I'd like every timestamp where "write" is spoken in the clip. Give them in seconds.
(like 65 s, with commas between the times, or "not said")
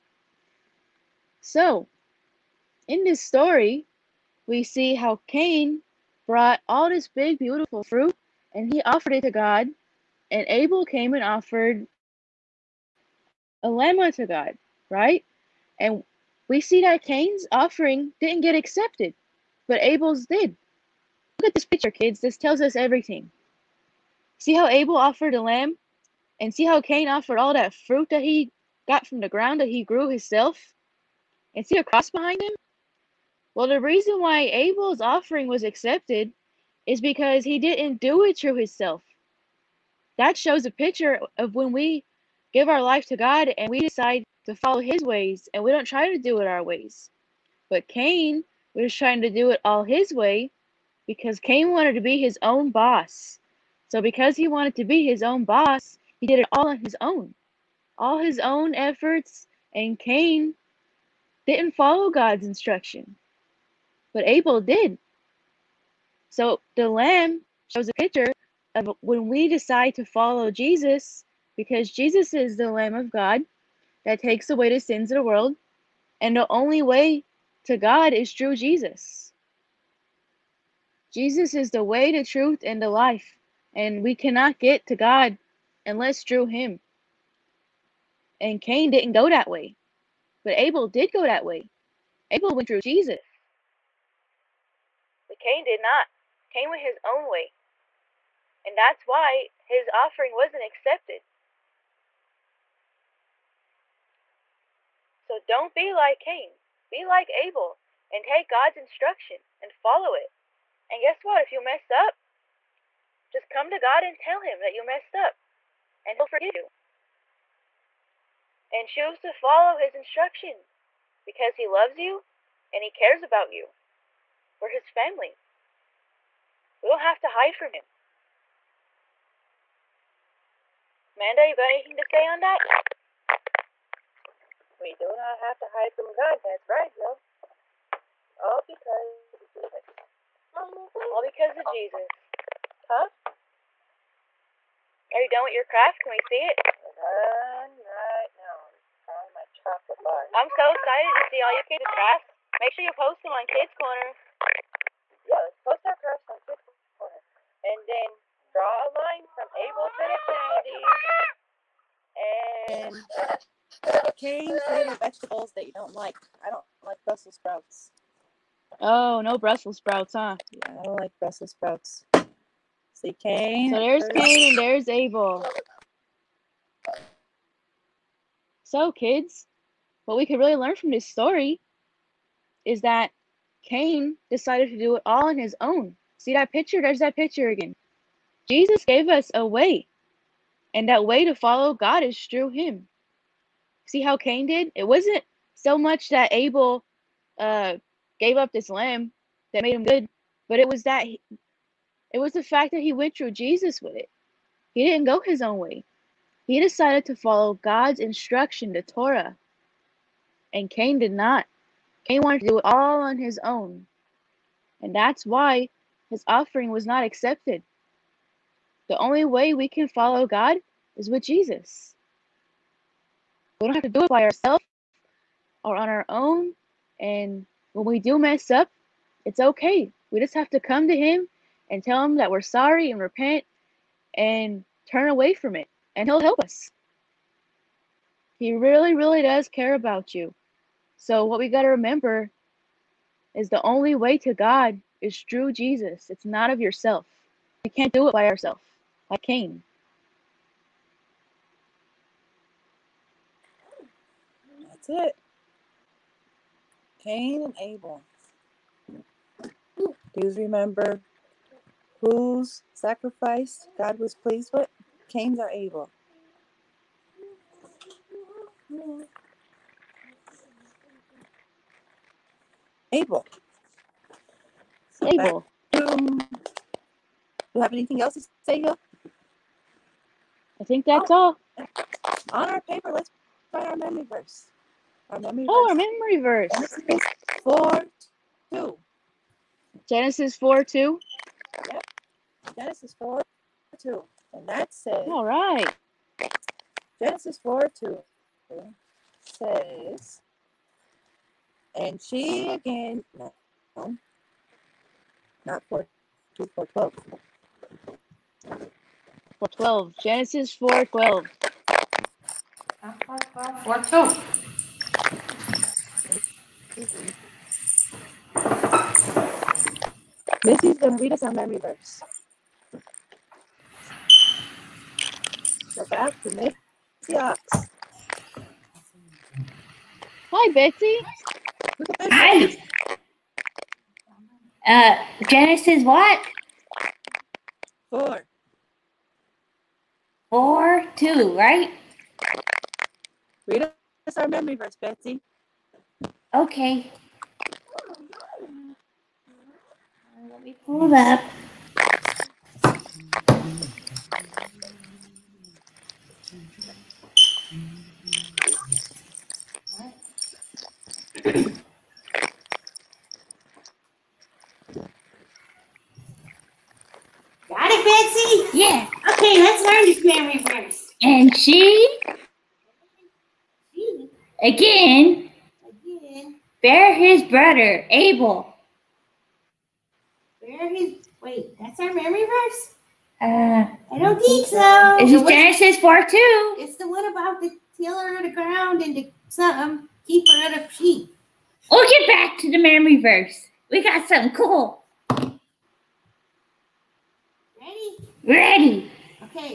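283 s.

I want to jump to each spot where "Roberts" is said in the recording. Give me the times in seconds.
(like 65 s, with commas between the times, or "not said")
not said.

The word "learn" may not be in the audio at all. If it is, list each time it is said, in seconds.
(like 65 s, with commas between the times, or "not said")
180 s, 369 s.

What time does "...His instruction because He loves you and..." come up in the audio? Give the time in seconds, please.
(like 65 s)
119 s.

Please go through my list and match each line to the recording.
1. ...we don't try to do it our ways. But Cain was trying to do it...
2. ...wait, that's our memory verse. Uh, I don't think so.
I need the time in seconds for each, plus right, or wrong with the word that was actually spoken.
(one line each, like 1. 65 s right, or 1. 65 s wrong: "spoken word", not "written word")
1. 45 s right
2. 381 s right.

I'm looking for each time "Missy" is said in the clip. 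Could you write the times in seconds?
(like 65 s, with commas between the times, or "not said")
316 s, 326 s.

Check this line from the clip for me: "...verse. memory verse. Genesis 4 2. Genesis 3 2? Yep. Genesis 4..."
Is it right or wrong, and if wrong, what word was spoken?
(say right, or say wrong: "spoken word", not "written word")
wrong: "4", not "3".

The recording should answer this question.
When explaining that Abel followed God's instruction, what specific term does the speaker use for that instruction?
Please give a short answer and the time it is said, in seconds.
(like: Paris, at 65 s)
the Torah, at 208 s.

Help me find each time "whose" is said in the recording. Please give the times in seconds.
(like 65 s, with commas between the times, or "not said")
261 s.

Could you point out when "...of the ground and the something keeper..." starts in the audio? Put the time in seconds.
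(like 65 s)
388 s.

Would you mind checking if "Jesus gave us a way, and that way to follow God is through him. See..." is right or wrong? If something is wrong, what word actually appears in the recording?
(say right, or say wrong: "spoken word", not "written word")
right.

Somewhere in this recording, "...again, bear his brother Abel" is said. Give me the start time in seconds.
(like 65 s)
374 s.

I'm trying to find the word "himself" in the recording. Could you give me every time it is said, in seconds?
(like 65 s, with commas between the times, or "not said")
30 s, 38 s.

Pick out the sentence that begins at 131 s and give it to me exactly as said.
Amanda, you got anything to say on that?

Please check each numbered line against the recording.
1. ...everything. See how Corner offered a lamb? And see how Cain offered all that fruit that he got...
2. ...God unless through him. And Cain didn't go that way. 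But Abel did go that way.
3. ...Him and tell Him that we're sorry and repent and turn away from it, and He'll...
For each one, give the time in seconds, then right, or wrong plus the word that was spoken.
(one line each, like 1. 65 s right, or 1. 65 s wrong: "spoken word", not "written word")
1. 22 s wrong: "Abel", not "Corner"
2. 84 s right
3. 230 s right.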